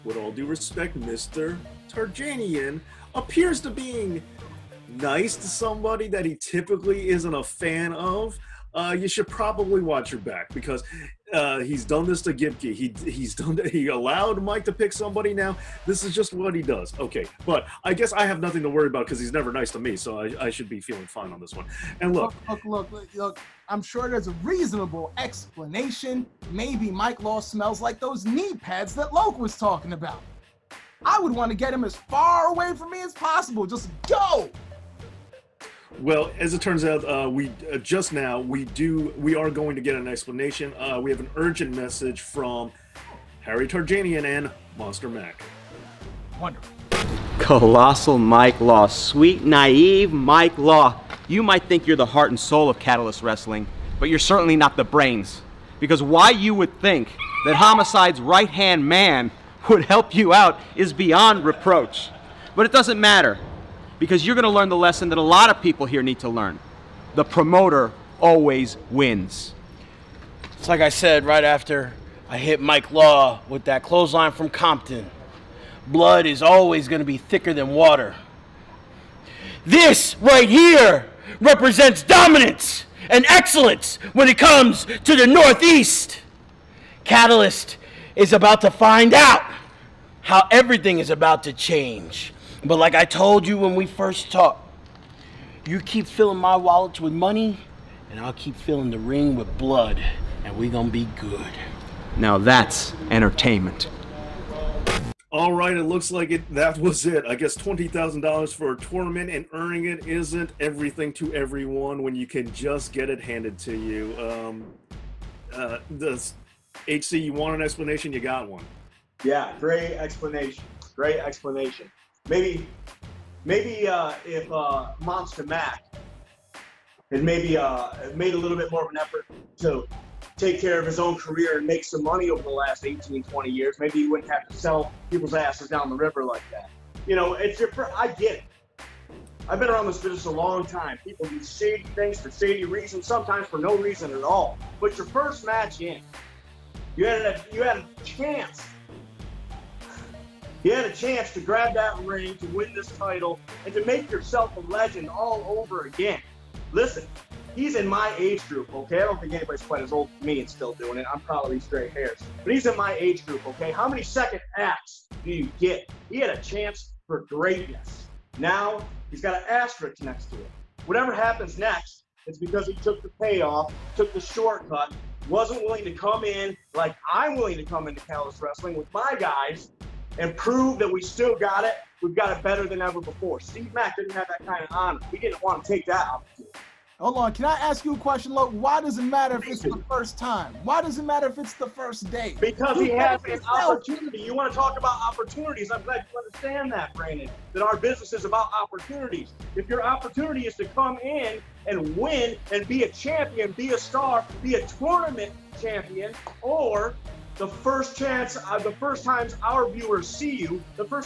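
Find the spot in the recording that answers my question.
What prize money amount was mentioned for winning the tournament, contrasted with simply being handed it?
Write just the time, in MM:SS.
01:47.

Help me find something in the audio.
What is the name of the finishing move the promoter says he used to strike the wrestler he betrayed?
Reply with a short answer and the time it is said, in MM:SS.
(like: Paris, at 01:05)
Clothesline from Compton, at 01:13.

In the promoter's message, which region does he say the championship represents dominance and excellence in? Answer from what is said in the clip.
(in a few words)
The Northeast.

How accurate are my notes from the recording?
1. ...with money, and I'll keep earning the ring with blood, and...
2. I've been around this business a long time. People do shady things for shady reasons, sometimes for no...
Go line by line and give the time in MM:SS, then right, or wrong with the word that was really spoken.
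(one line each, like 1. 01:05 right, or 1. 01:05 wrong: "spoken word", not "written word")
1. 01:37 wrong: "filling", not "earning"
2. 02:19 right.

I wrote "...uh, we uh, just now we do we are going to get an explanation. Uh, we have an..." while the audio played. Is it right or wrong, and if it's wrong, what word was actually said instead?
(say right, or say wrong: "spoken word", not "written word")
right.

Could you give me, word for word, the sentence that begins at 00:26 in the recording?
Maybe Mike Law smells like those knee pads that Loc was talking about.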